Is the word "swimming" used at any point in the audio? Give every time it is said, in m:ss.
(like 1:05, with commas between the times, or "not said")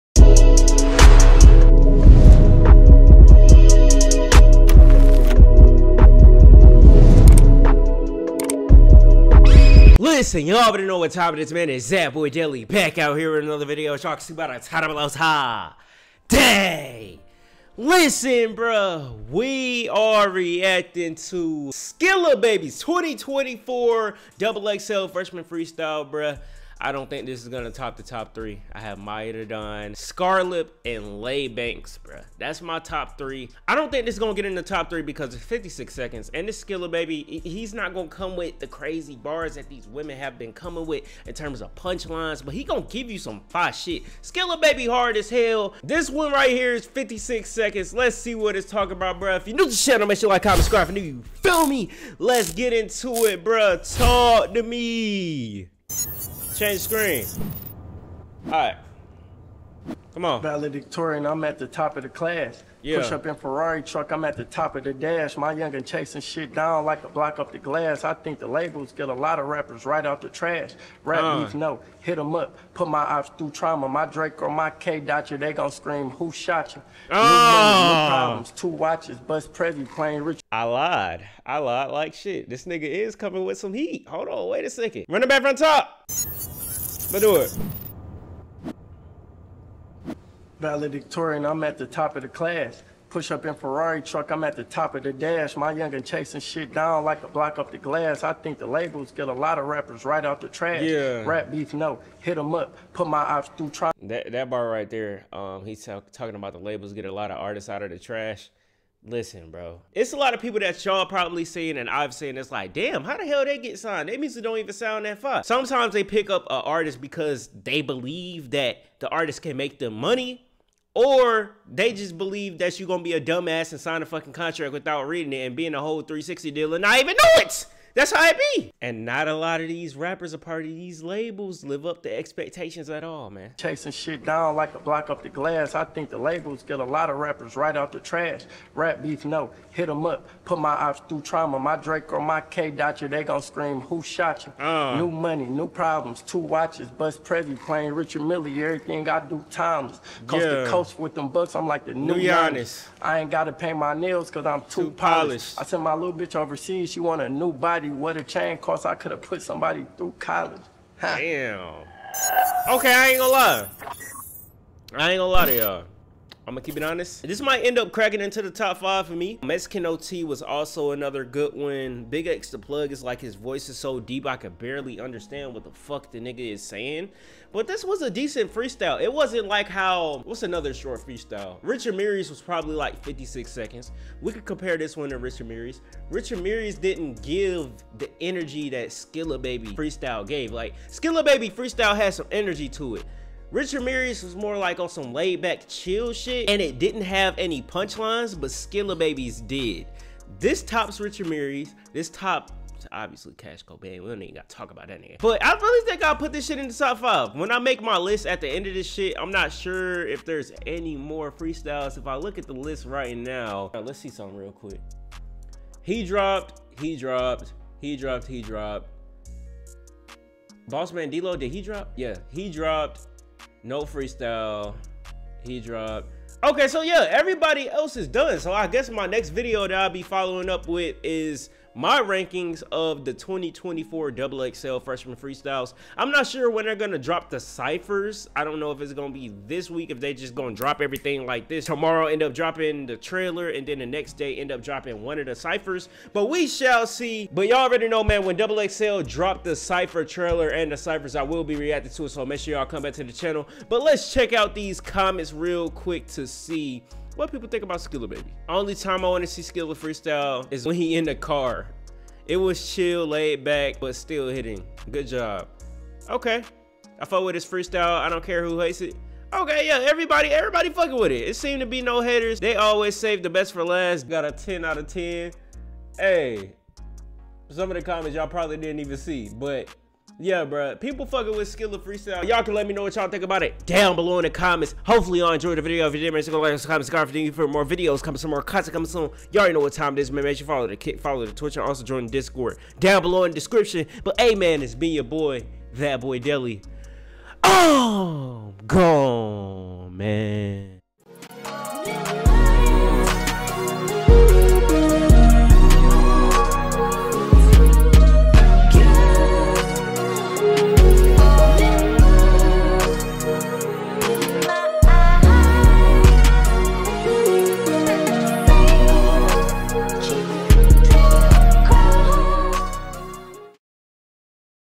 not said.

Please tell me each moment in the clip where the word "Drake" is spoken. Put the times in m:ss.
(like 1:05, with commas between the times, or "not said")
1:14, 2:21.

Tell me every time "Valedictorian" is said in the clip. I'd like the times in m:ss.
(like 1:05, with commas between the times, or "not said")
1:00, 1:30.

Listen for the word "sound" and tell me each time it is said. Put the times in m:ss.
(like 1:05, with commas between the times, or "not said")
1:54.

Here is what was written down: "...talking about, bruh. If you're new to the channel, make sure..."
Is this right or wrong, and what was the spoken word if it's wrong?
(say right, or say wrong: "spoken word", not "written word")
right.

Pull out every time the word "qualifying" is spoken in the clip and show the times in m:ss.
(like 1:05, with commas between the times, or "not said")
not said.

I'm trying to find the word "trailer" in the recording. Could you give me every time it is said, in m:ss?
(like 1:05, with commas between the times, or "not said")
4:02, 4:10.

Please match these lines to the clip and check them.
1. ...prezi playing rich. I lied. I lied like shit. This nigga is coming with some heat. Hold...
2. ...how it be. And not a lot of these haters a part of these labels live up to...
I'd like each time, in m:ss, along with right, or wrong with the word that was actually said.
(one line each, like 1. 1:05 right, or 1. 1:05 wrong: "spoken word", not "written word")
1. 1:19 right
2. 2:08 wrong: "rappers", not "haters".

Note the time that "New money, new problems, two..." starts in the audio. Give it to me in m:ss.
2:24.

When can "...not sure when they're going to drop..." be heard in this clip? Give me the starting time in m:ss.
3:56.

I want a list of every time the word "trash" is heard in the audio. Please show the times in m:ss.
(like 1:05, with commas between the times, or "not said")
1:10, 1:40, 1:47, 2:17.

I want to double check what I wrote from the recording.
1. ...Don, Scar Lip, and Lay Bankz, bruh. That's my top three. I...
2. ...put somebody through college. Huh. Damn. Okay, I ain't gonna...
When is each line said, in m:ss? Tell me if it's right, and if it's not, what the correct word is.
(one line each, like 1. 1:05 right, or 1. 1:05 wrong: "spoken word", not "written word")
1. 0:29 right
2. 2:39 right.